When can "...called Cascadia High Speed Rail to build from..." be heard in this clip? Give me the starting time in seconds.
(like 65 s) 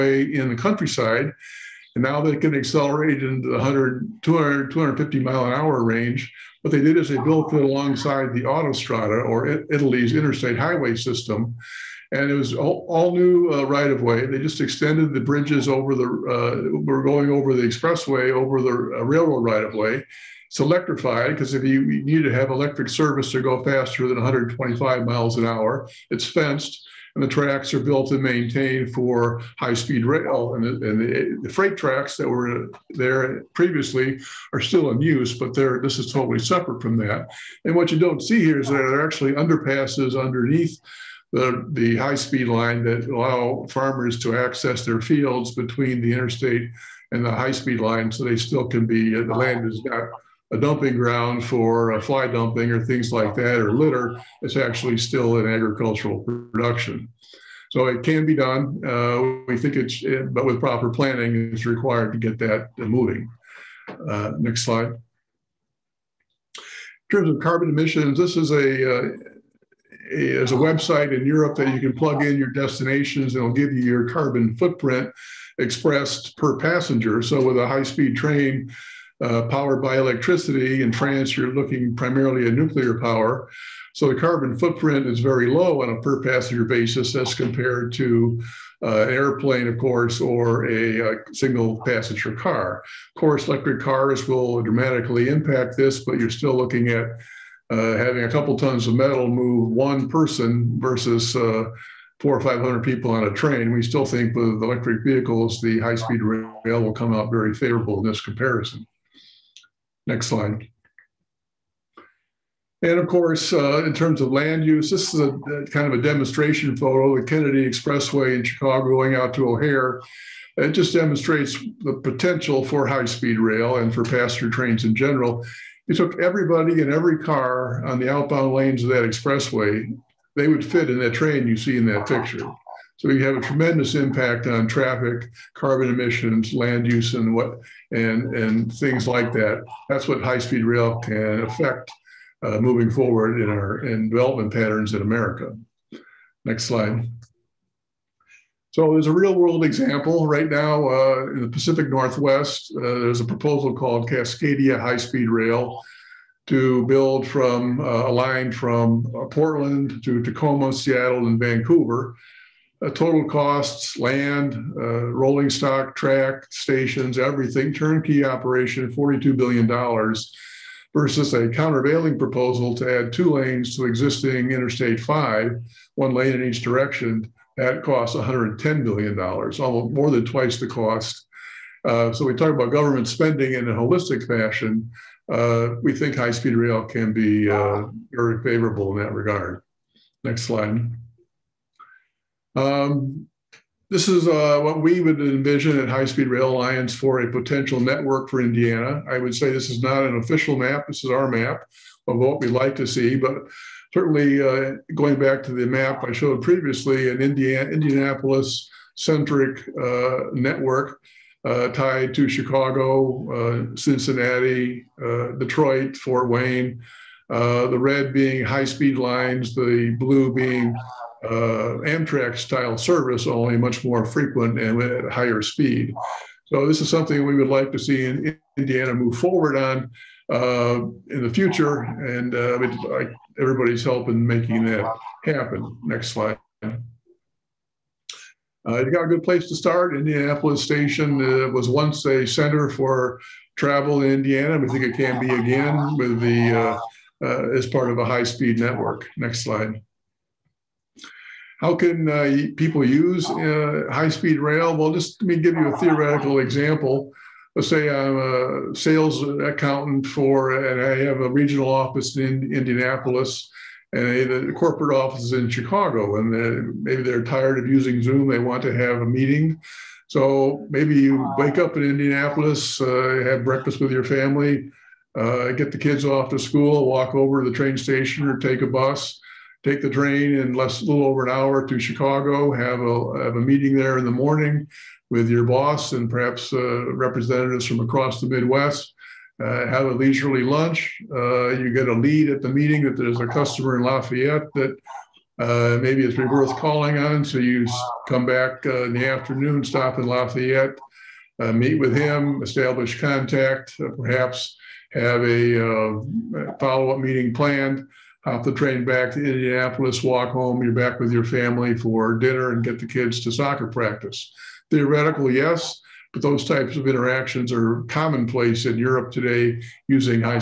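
153 s.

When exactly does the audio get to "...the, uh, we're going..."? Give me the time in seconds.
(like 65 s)
15 s.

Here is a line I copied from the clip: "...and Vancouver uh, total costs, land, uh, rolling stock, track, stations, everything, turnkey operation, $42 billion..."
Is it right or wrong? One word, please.
right.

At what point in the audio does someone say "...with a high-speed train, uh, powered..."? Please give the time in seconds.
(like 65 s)
77 s.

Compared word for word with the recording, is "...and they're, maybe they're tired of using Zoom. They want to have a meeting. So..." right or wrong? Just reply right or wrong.
right.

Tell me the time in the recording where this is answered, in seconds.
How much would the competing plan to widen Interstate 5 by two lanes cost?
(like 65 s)
178 s.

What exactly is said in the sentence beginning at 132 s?
So we have a tremendous impact on traffic, carbon emissions, land use, and what and and things like that.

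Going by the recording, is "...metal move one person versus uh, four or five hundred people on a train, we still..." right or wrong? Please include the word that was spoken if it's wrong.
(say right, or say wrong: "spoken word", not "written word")
right.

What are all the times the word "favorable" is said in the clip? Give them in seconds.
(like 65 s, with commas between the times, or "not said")
107 s, 188 s.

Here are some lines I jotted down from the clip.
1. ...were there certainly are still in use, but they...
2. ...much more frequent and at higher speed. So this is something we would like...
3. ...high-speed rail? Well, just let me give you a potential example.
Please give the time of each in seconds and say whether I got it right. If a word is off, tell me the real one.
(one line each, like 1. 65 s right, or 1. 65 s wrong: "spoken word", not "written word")
1. 32 s wrong: "previously", not "certainly"
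2. 223 s right
3. 253 s wrong: "theoretical", not "potential".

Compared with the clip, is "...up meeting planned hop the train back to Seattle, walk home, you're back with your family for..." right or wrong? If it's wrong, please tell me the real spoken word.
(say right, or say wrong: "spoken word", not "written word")
wrong: "Indianapolis", not "Seattle".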